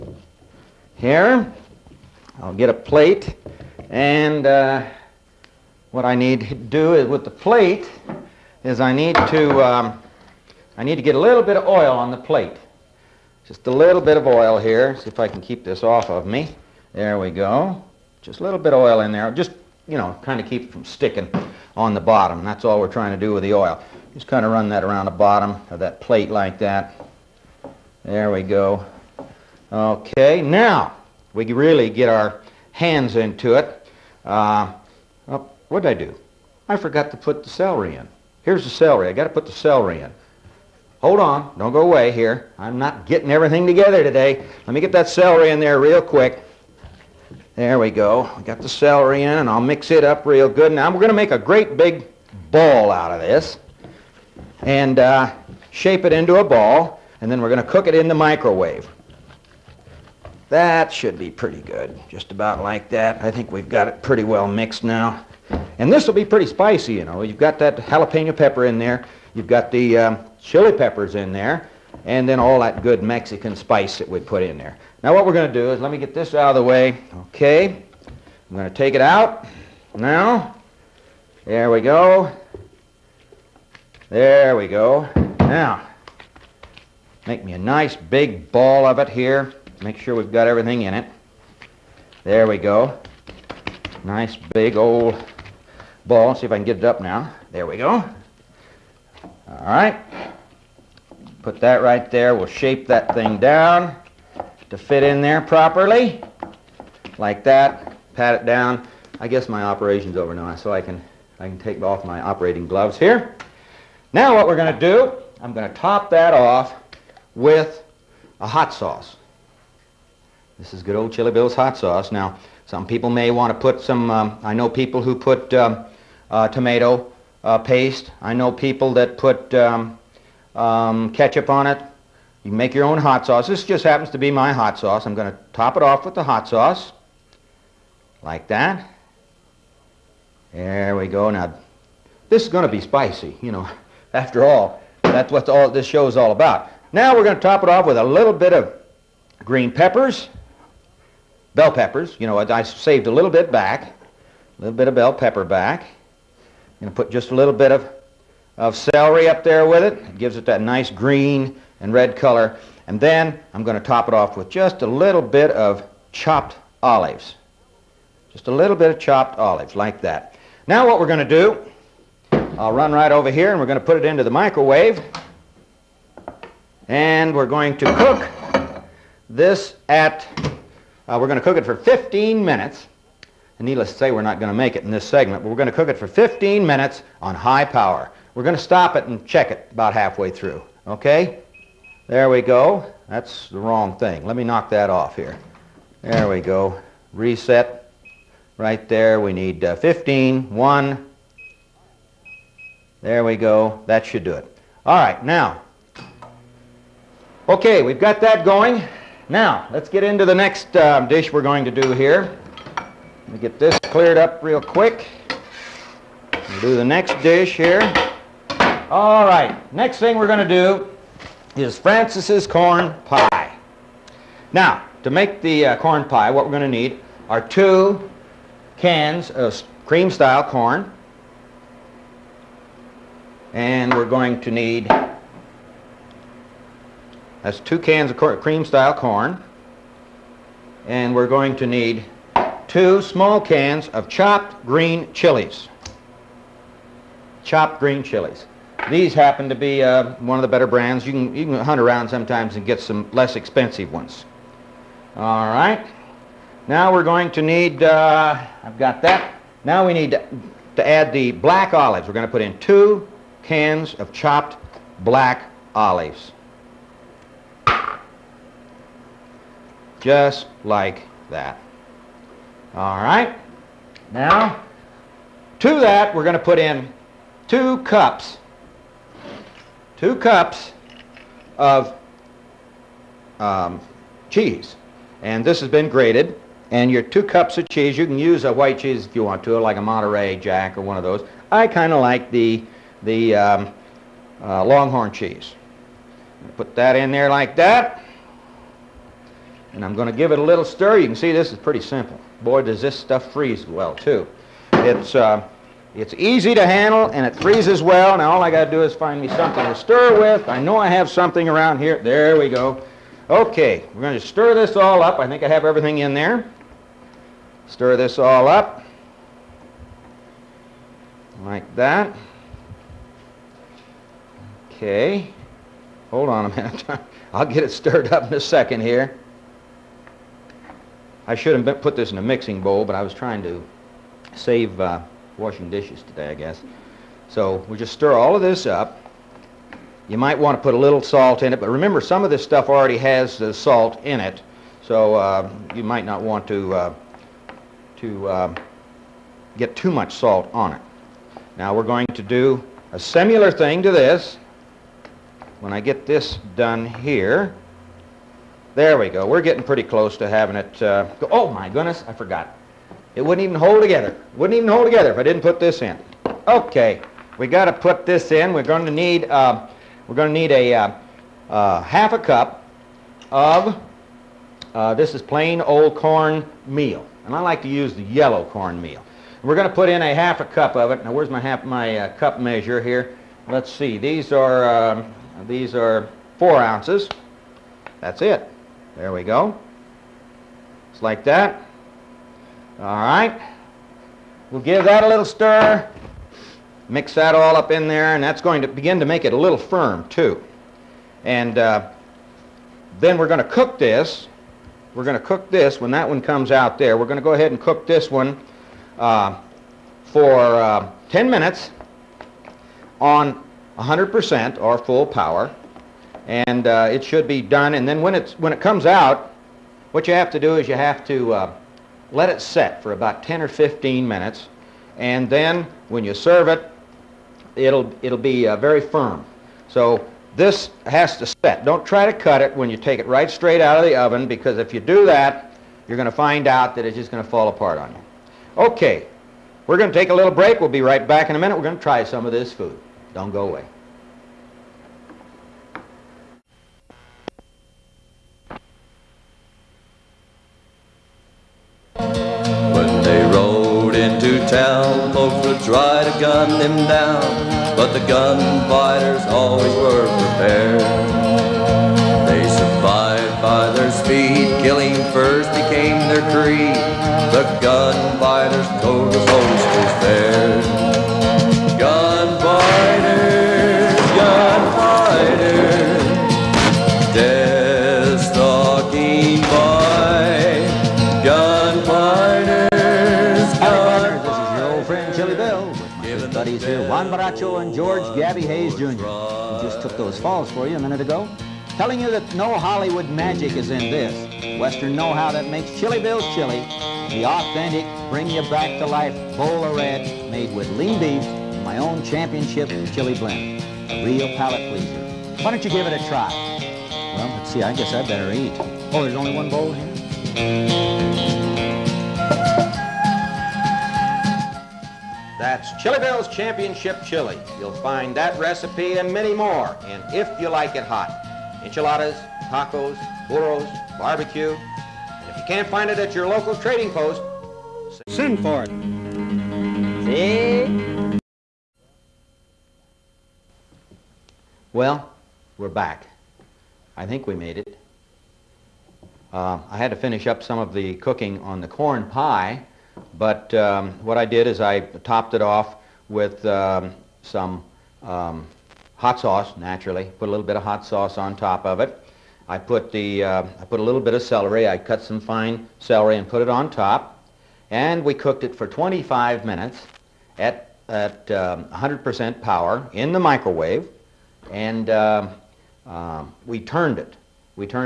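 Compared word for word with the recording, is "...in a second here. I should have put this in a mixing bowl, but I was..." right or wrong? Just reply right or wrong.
right.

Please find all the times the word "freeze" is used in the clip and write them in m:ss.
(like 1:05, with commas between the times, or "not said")
5:03, 5:07.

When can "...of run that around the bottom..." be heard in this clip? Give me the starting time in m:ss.
0:24.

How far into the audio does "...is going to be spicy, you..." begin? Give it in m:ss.
2:22.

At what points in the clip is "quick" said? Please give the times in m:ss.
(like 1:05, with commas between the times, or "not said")
0:46, 3:34.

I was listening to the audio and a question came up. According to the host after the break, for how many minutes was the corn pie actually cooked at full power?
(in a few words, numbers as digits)
25.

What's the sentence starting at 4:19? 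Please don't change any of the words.
Now we need to, to add the black olives.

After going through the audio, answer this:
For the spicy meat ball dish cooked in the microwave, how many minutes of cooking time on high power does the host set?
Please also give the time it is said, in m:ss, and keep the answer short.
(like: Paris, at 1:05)
15, at 3:06.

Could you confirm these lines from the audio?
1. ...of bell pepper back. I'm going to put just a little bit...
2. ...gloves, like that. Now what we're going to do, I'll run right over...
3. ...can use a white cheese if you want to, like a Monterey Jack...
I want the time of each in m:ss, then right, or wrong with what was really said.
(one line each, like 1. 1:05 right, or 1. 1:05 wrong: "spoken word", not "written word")
1. 2:34 right
2. 2:49 wrong: "olives", not "gloves"
3. 4:48 right.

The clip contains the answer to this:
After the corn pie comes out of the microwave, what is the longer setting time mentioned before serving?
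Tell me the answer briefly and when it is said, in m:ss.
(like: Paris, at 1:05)
15 minutes, at 7:03.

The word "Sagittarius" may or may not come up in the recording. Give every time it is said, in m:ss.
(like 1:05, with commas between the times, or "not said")
not said.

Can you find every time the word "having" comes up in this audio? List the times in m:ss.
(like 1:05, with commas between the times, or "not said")
6:00.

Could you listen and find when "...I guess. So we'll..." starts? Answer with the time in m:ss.
5:36.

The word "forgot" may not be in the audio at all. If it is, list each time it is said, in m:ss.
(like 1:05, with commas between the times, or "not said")
0:36, 6:02.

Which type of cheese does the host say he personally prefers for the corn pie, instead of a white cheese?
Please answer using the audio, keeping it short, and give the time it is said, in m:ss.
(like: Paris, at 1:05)
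Longhorn, at 4:54.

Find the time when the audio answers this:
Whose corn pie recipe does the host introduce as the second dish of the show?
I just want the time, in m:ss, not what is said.
3:41.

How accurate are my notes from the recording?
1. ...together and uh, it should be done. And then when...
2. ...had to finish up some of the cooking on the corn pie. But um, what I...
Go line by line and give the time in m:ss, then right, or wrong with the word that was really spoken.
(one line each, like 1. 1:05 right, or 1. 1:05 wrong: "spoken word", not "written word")
1. 6:55 wrong: "power", not "together"
2. 8:59 right.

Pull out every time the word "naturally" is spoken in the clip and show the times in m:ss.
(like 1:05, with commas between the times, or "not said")
9:09.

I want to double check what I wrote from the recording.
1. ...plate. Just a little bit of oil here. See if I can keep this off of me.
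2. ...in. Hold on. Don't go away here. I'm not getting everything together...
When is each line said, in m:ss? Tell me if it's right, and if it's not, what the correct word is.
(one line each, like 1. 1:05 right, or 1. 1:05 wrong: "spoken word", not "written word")
1. 0:12 right
2. 0:40 right.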